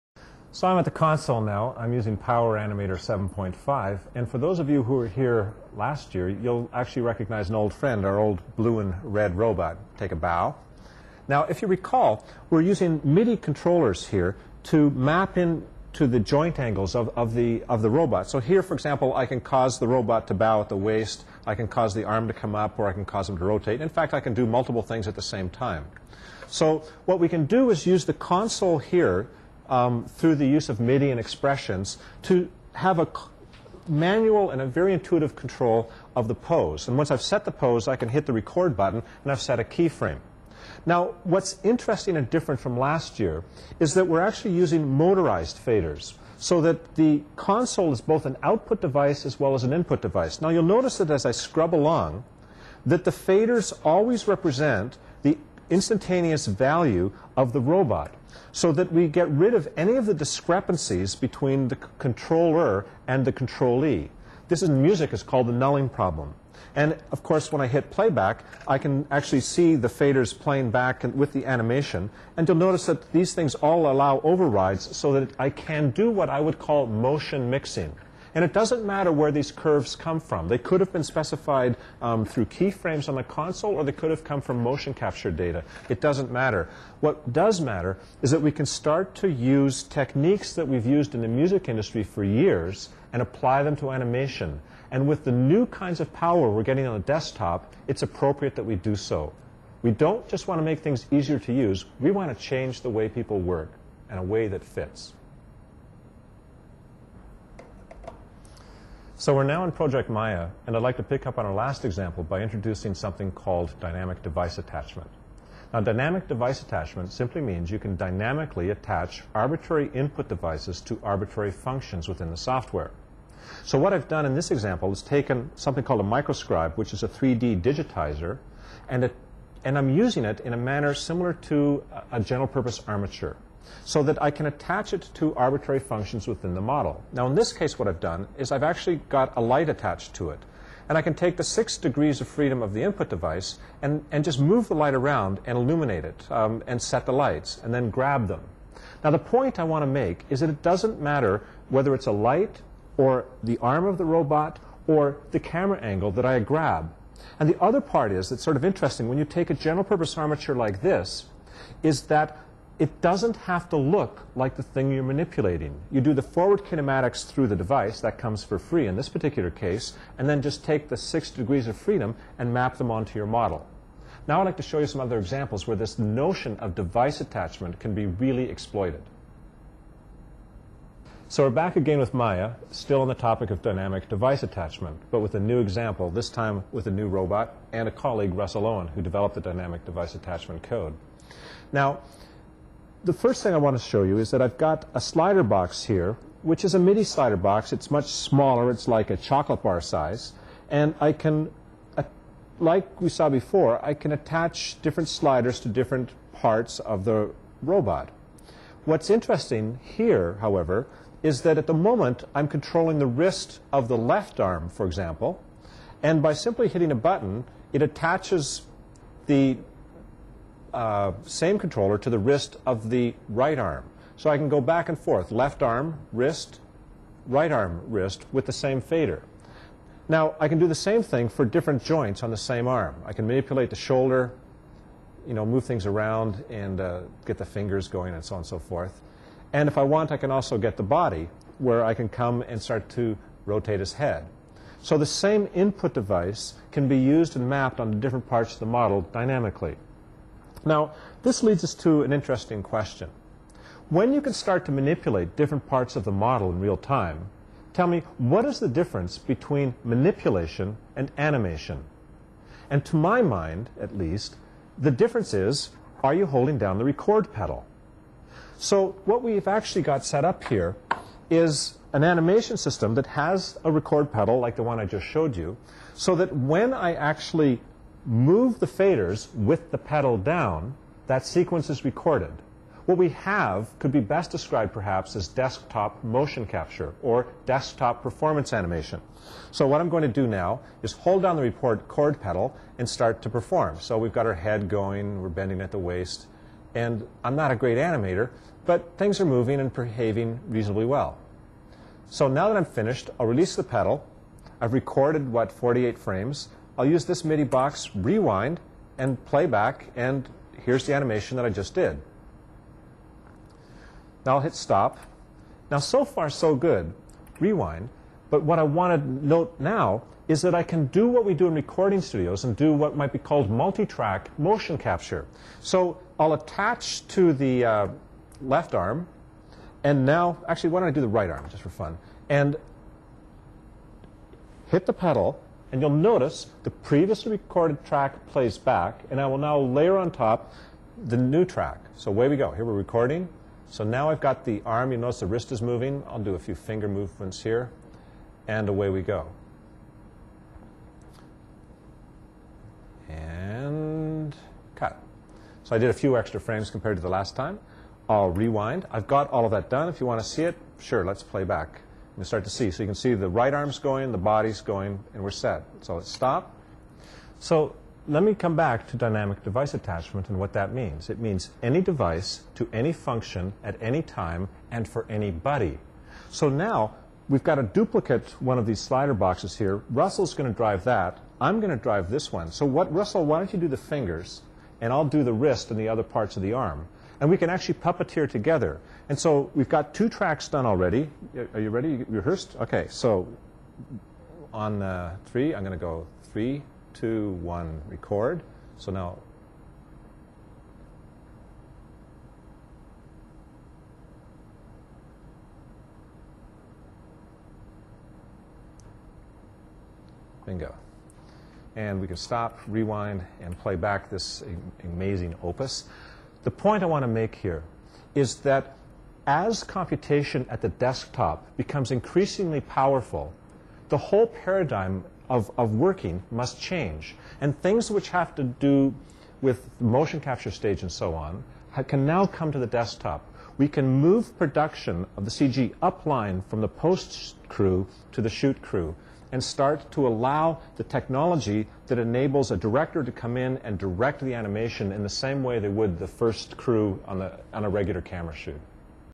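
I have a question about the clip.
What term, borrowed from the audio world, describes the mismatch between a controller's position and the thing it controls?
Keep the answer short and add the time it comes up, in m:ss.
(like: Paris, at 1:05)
nulling problem, at 1:05.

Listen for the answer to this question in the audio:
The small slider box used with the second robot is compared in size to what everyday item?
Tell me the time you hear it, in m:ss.
3:19.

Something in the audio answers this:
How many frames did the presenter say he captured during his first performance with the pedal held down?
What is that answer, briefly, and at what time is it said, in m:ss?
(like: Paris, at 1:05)
48, at 5:05.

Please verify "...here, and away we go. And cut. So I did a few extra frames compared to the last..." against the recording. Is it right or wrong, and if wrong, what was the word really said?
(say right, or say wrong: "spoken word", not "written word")
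right.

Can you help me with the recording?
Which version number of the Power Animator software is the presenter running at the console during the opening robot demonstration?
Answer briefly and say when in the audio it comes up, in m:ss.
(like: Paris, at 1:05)
7.5, at 0:02.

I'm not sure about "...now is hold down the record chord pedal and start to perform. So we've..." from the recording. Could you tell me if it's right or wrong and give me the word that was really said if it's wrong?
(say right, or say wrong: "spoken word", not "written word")
right.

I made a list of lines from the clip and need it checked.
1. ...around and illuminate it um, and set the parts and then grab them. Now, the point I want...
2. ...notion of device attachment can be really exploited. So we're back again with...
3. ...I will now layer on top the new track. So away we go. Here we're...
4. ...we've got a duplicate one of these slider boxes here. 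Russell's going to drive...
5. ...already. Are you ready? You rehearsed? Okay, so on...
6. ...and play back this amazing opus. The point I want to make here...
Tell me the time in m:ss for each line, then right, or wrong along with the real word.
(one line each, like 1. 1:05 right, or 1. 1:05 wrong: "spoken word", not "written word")
1. 2:24 wrong: "lights", not "parts"
2. 2:55 right
3. 5:39 right
4. 6:17 right
5. 6:30 right
6. 6:53 right.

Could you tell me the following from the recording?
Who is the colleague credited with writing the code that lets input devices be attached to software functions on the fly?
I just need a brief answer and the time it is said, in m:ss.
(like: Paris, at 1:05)
Russell Owen, at 3:08.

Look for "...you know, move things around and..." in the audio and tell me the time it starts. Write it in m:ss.
3:55.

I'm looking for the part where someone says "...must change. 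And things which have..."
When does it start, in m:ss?
7:06.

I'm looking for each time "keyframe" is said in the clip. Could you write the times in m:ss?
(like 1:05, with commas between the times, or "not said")
0:39, 1:22.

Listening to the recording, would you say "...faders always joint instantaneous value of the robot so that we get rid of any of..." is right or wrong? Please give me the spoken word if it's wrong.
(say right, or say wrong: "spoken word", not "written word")
wrong: "represent", not "joint".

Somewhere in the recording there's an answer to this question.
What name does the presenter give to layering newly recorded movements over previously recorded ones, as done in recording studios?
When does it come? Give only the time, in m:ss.
5:23.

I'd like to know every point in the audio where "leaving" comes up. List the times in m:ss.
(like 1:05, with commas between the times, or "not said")
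not said.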